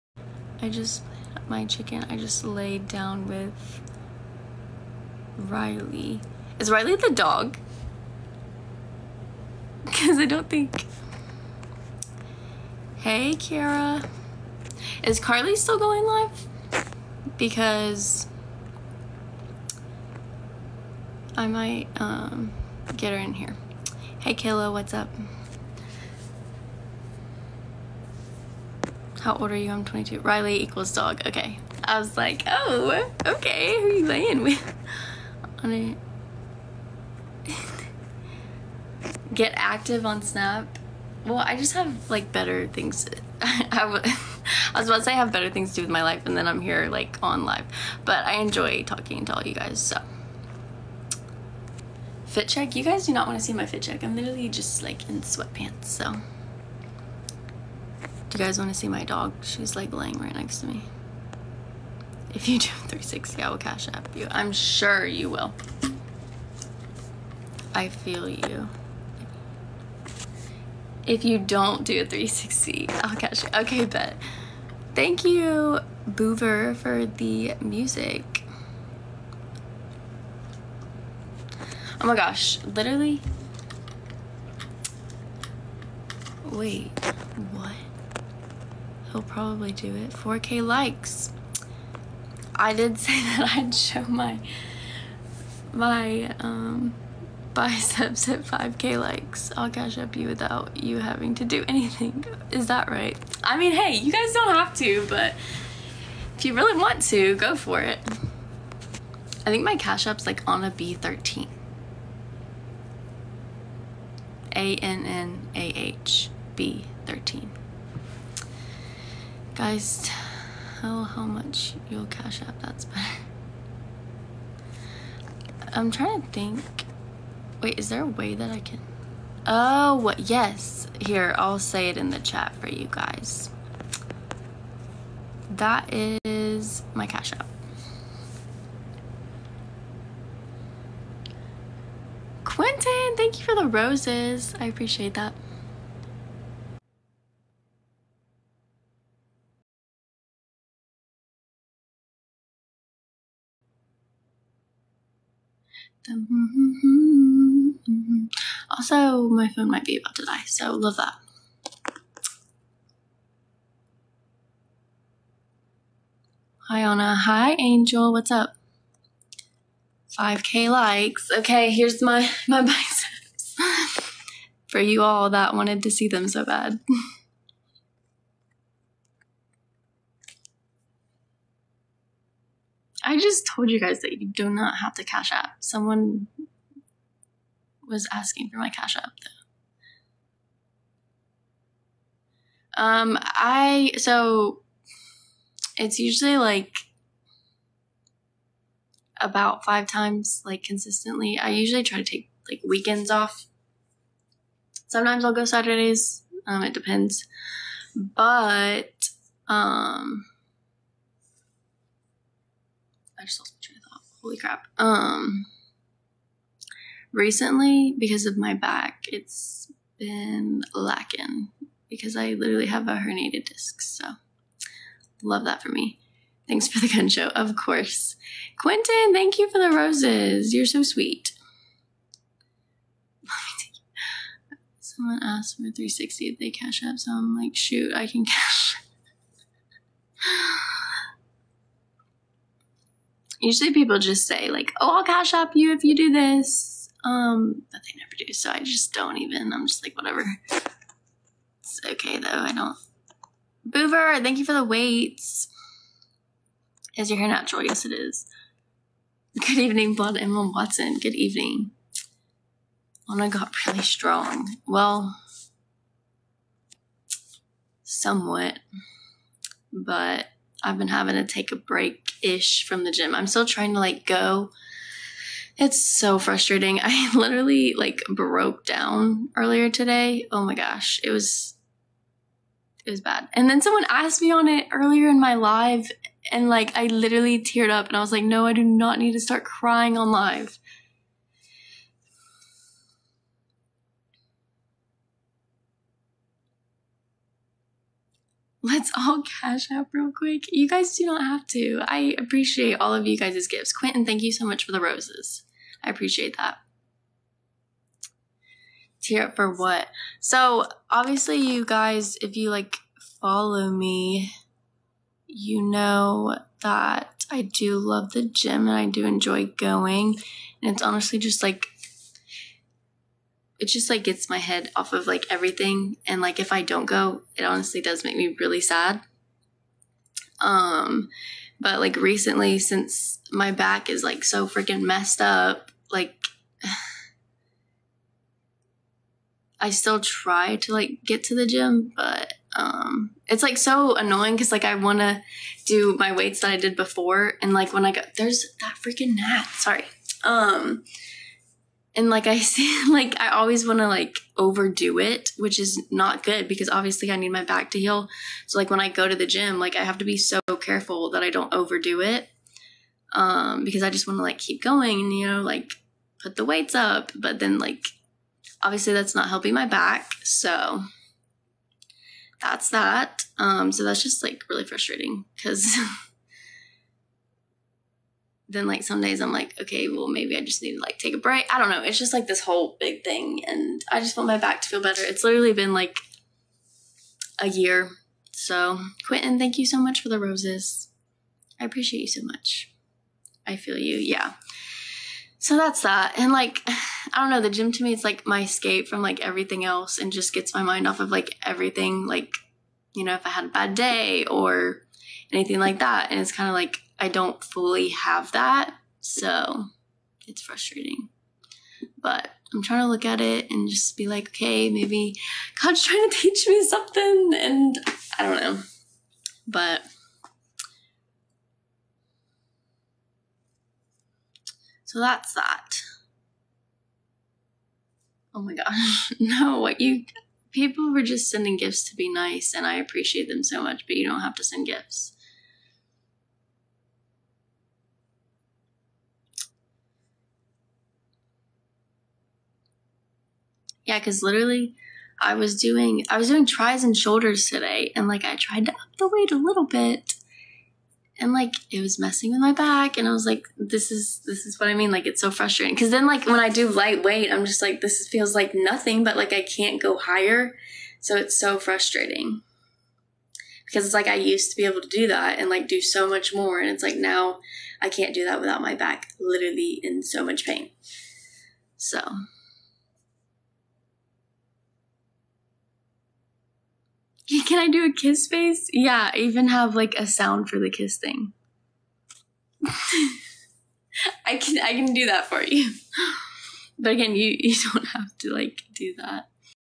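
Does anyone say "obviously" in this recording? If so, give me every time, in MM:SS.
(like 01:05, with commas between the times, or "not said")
05:10, 05:56, 06:08.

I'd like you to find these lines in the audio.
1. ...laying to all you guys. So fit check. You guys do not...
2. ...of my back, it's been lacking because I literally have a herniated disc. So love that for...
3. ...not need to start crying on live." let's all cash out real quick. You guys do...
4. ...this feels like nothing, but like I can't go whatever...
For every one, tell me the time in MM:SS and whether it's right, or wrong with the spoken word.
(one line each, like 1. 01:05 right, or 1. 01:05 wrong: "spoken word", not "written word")
1. 00:48 wrong: "talking", not "laying"
2. 03:38 right
3. 04:48 right
4. 07:37 wrong: "higher", not "whatever".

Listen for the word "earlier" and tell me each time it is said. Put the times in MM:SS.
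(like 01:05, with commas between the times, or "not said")
04:39, 04:44.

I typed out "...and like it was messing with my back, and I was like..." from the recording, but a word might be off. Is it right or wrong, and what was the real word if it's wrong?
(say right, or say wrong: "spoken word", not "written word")
right.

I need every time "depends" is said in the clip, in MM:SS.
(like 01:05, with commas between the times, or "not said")
03:26.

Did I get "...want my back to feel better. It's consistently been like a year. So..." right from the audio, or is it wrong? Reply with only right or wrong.
wrong.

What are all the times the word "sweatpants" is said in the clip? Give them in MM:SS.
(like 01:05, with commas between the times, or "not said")
00:55.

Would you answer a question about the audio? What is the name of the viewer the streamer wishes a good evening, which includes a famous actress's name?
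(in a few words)
Blood Emma Watson.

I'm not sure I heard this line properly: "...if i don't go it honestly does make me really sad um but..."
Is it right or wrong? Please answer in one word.
right.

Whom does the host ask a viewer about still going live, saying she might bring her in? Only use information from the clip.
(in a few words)
Carly.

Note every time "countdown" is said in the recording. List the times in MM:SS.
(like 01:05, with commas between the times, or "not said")
not said.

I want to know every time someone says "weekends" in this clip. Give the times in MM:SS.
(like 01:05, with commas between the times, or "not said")
03:22.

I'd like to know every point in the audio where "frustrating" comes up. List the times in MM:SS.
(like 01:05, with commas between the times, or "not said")
04:36, 06:14, 06:50, 07:35, 07:41.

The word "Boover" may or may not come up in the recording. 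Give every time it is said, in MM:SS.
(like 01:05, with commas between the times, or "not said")
01:16, 04:13.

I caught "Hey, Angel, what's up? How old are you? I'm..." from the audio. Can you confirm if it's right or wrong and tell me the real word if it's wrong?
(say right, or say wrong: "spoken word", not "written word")
wrong: "Kayla", not "Angel".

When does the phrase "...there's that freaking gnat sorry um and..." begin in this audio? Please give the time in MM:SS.
05:48.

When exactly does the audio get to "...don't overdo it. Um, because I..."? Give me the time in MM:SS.
06:01.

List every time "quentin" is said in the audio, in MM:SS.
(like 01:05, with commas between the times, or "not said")
02:22, 03:48, 05:03, 06:29.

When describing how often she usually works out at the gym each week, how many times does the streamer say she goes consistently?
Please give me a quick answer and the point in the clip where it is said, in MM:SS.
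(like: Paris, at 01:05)
5, at 03:19.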